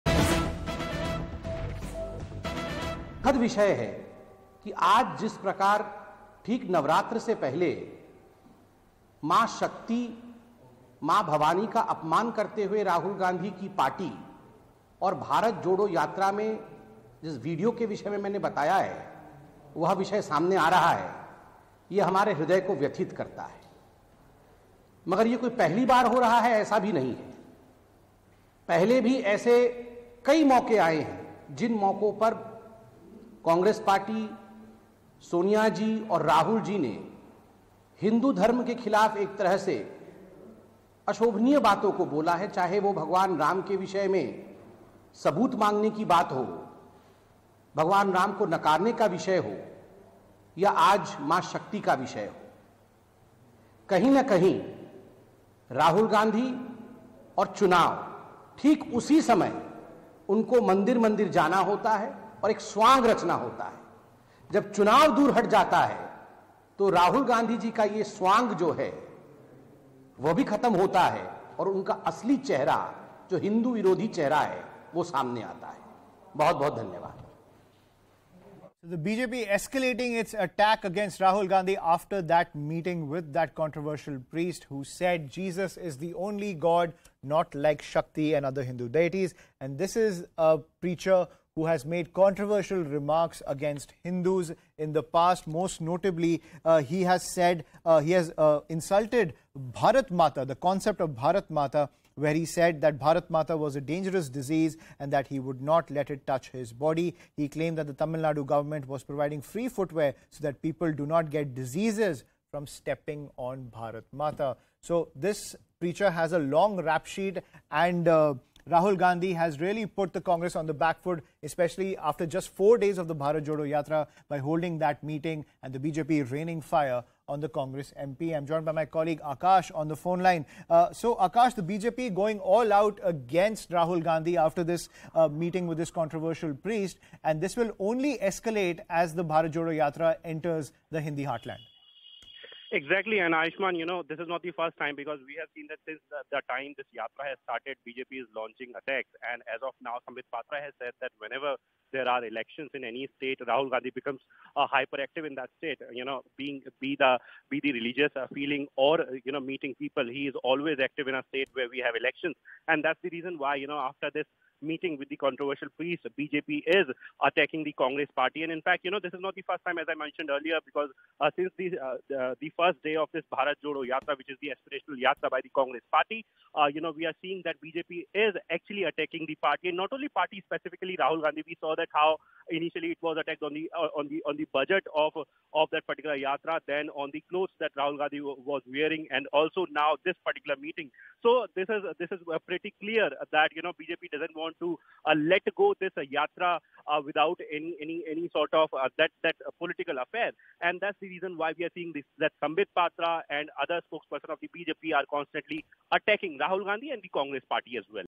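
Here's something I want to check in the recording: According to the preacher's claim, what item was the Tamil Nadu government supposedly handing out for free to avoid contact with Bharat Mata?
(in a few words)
footwear.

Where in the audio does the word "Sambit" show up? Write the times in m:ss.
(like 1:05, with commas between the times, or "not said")
2:30, 3:22.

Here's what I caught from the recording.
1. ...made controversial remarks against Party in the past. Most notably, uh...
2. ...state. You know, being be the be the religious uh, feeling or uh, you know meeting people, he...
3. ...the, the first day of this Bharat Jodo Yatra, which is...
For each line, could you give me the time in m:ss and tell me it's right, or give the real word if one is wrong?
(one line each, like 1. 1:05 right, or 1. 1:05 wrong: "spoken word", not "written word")
1. 1:31 wrong: "Hindus", not "Party"
2. 2:35 right
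3. 2:52 right.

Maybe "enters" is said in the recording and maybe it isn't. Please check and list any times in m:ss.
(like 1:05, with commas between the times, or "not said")
2:20.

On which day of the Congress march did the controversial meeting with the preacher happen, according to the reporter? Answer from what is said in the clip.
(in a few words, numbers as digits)
4.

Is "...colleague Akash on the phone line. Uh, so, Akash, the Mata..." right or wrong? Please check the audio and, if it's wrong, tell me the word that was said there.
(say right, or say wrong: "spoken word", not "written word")
wrong: "BJP", not "Mata".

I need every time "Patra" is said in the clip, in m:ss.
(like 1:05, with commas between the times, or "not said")
2:30, 3:22.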